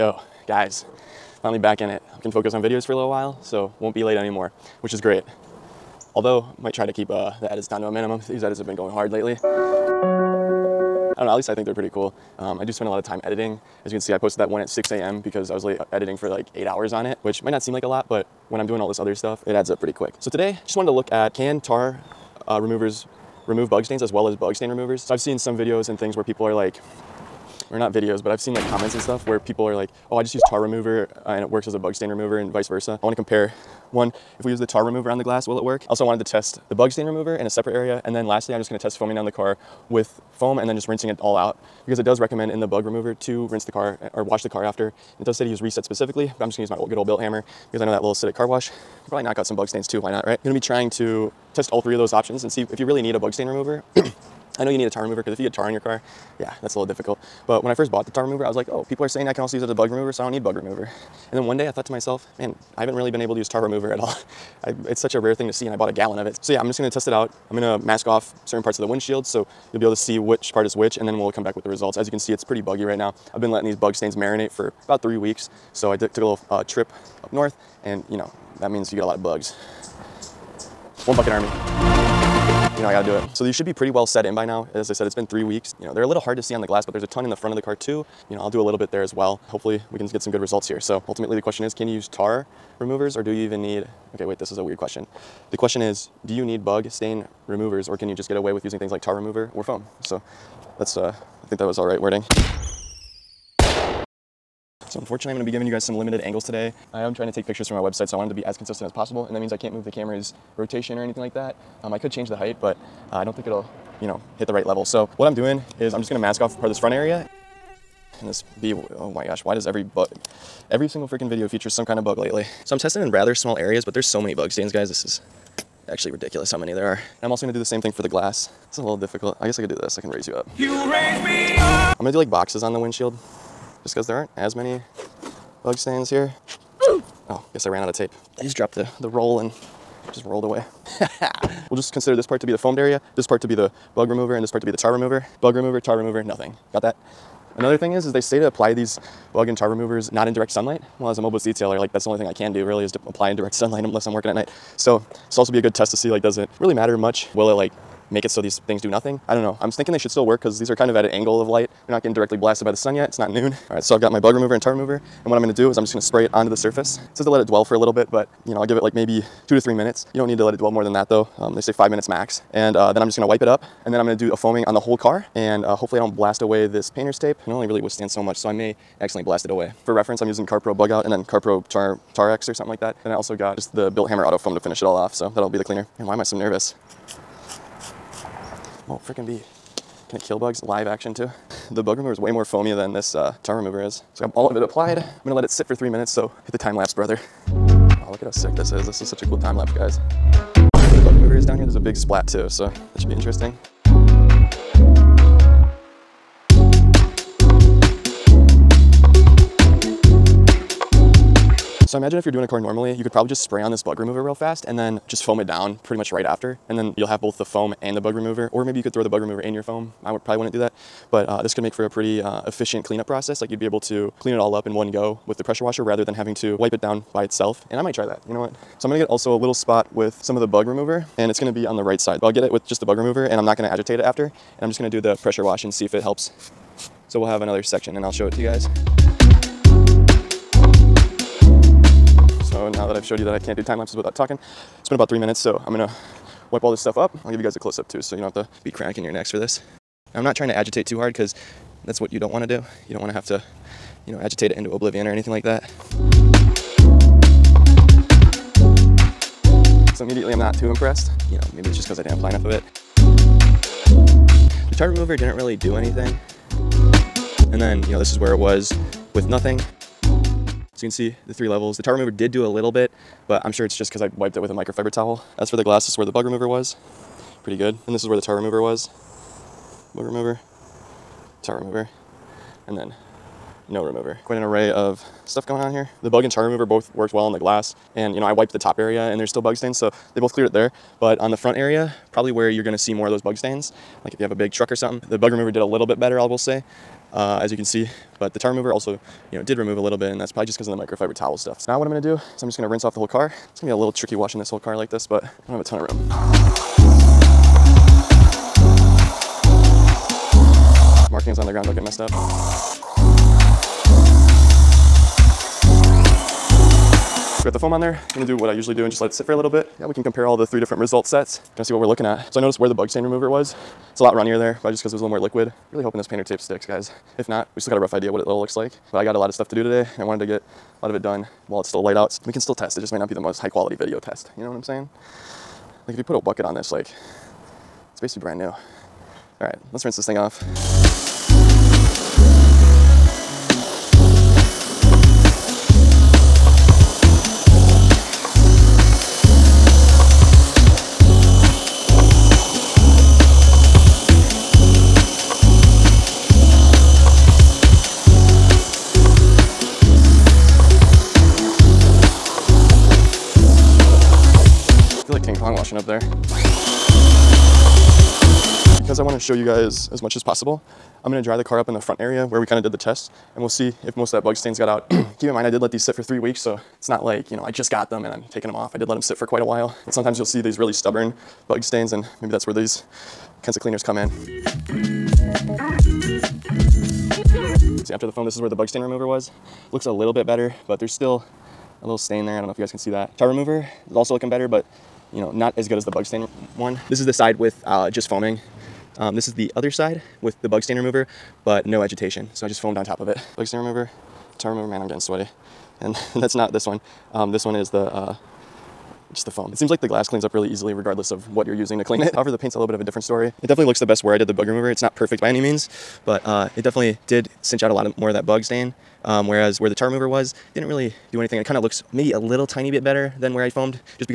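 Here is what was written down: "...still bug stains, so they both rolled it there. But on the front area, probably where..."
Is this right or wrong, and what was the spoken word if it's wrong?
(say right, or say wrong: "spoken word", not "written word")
wrong: "cleared", not "rolled".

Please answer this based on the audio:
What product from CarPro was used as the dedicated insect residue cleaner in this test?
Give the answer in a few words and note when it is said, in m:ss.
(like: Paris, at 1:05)
CarPro Bug Out, at 3:00.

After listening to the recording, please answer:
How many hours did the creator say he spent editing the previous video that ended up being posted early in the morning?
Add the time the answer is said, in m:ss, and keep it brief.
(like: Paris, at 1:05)
8, at 0:16.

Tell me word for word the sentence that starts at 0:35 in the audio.
Also wanted to test the bug stain remover in a separate area.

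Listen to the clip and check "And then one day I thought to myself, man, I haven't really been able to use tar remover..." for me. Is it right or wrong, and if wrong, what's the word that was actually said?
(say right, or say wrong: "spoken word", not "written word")
right.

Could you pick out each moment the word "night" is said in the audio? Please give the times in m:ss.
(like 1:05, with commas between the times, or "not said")
2:34.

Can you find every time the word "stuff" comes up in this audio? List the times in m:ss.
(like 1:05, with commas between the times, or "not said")
0:19, 0:28, 4:06, 4:45, 5:01, 5:29.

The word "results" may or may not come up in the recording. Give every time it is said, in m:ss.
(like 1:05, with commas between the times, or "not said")
1:11, 1:30, 5:20.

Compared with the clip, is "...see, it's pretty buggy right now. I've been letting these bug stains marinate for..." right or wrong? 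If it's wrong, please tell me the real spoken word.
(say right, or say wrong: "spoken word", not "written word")
right.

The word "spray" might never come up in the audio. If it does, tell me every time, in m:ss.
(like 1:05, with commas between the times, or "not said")
2:46, 3:33.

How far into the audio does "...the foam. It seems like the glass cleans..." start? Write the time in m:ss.
6:49.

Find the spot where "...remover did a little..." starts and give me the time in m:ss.
4:55.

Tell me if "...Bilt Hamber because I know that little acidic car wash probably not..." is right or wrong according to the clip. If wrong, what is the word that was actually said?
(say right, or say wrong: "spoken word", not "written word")
right.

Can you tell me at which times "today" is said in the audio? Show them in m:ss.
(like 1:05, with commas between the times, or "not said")
0:20, 1:46, 5:29.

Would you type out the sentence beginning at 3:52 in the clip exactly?
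But I'll get it with just the bug remover and I'm not gonna agitate it after.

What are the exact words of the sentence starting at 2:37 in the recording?
Will it like make it so these things do nothing.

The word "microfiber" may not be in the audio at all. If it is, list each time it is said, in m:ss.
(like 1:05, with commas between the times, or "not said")
4:34, 5:00.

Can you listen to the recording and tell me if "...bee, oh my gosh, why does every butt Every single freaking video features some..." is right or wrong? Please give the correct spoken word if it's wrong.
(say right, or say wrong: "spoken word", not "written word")
right.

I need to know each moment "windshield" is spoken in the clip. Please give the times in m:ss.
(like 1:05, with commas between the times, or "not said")
1:08, 2:12.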